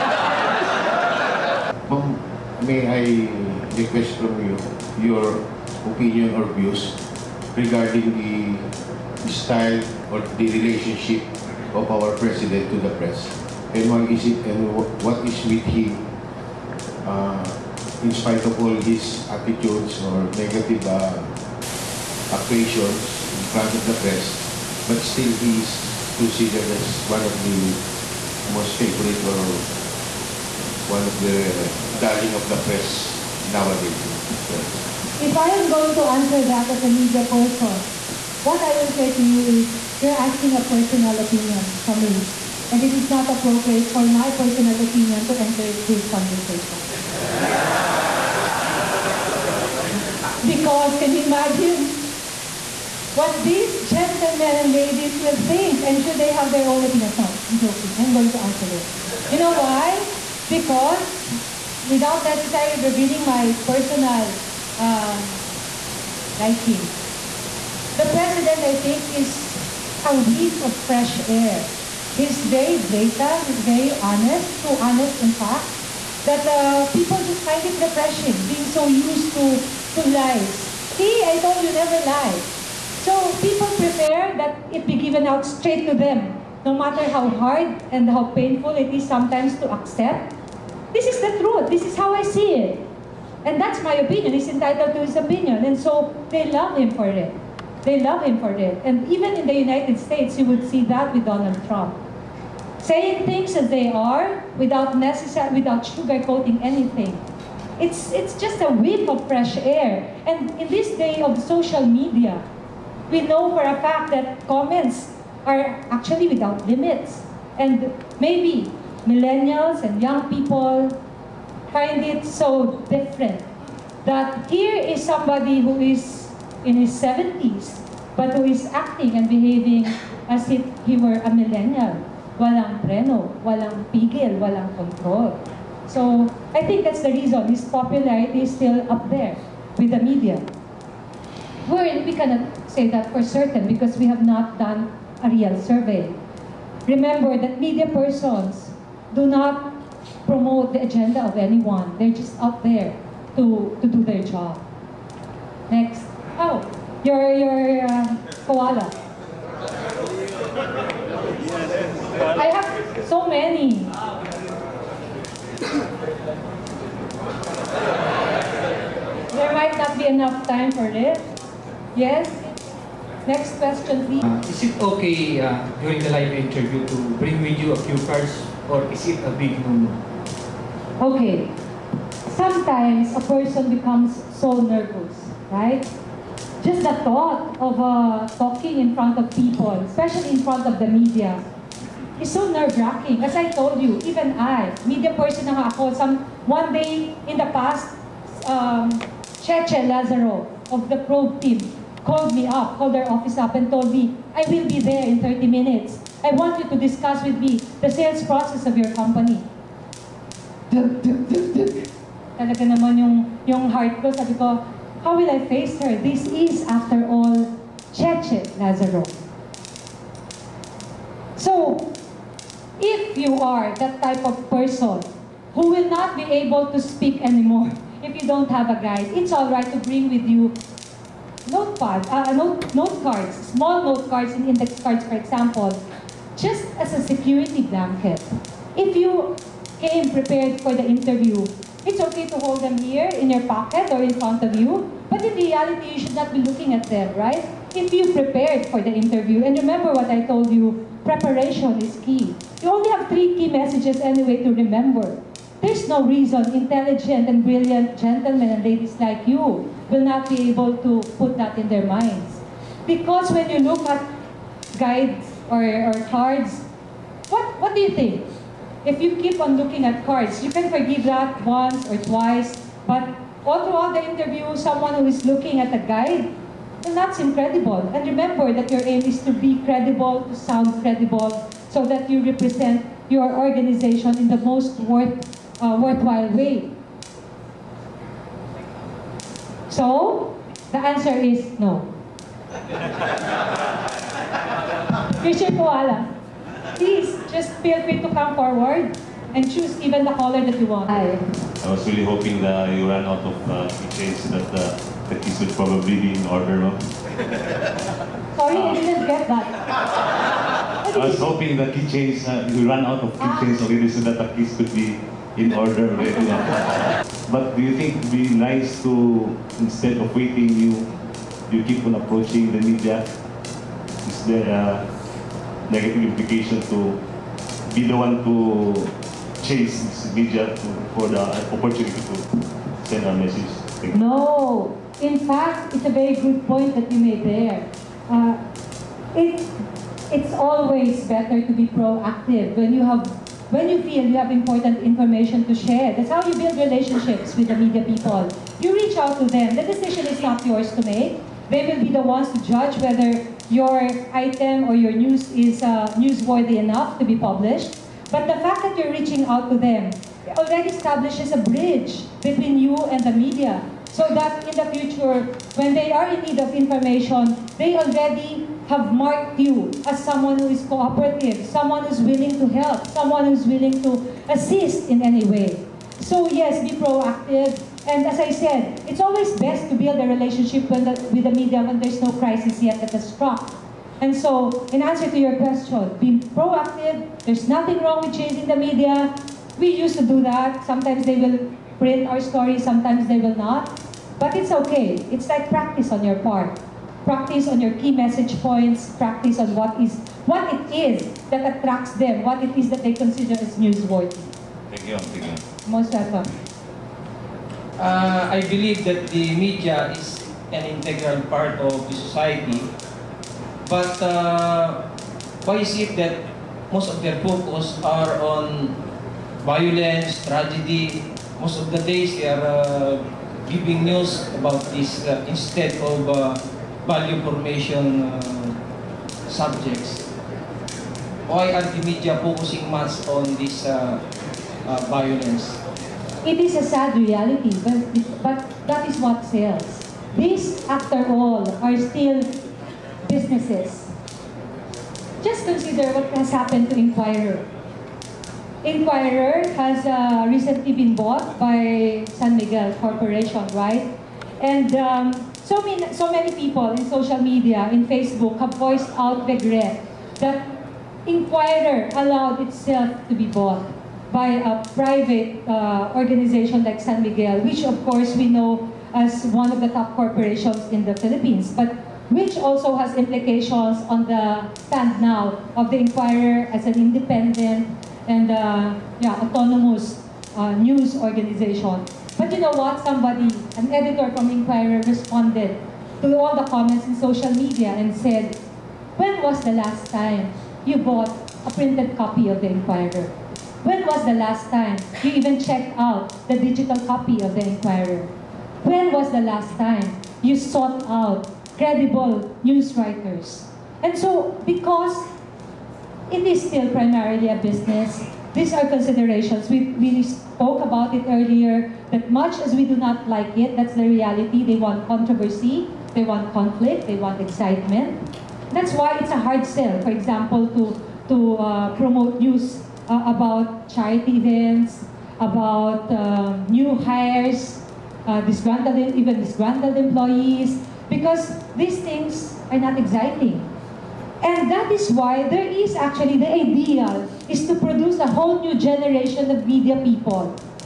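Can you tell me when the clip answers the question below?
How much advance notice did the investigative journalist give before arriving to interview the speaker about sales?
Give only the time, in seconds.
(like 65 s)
205 s.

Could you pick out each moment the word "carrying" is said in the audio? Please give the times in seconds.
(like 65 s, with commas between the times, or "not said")
not said.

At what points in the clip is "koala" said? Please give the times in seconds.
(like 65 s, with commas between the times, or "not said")
158 s, 295 s.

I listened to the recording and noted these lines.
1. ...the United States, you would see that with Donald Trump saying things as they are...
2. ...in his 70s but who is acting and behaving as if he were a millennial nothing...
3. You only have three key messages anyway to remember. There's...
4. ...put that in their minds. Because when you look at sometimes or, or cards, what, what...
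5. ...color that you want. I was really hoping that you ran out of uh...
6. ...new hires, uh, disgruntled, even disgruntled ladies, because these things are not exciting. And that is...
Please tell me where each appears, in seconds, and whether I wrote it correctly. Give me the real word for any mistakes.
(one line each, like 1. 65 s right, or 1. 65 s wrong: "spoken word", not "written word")
1. 99 s right
2. 126 s wrong: "walang", not "nothing"
3. 252 s right
4. 261 s wrong: "guides", not "sometimes"
5. 300 s right
6. 526 s wrong: "employees", not "ladies".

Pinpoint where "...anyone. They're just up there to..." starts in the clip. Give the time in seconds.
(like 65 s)
151 s.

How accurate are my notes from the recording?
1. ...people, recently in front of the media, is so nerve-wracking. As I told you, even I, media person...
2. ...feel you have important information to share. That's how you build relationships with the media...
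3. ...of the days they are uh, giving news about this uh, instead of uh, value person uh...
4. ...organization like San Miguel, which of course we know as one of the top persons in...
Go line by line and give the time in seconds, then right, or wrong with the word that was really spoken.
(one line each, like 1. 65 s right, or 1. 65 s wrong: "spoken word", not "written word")
1. 189 s wrong: "especially", not "recently"
2. 343 s right
3. 421 s wrong: "formation", not "person"
4. 465 s wrong: "corporations", not "persons".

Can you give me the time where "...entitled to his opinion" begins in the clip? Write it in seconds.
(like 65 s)
94 s.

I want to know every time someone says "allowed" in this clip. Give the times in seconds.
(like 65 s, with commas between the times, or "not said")
461 s.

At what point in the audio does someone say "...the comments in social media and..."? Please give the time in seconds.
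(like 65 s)
486 s.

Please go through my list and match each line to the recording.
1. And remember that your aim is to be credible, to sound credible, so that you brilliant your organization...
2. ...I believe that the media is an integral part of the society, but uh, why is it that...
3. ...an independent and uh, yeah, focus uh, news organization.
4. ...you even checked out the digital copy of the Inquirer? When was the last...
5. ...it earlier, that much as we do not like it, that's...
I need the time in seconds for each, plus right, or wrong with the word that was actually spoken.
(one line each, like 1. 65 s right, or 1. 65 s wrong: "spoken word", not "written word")
1. 277 s wrong: "represent", not "brilliant"
2. 408 s right
3. 476 s wrong: "autonomous", not "focus"
4. 495 s right
5. 510 s right.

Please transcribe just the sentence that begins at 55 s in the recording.
I'm sure they have their own opinions.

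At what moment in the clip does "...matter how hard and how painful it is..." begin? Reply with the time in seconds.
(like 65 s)
86 s.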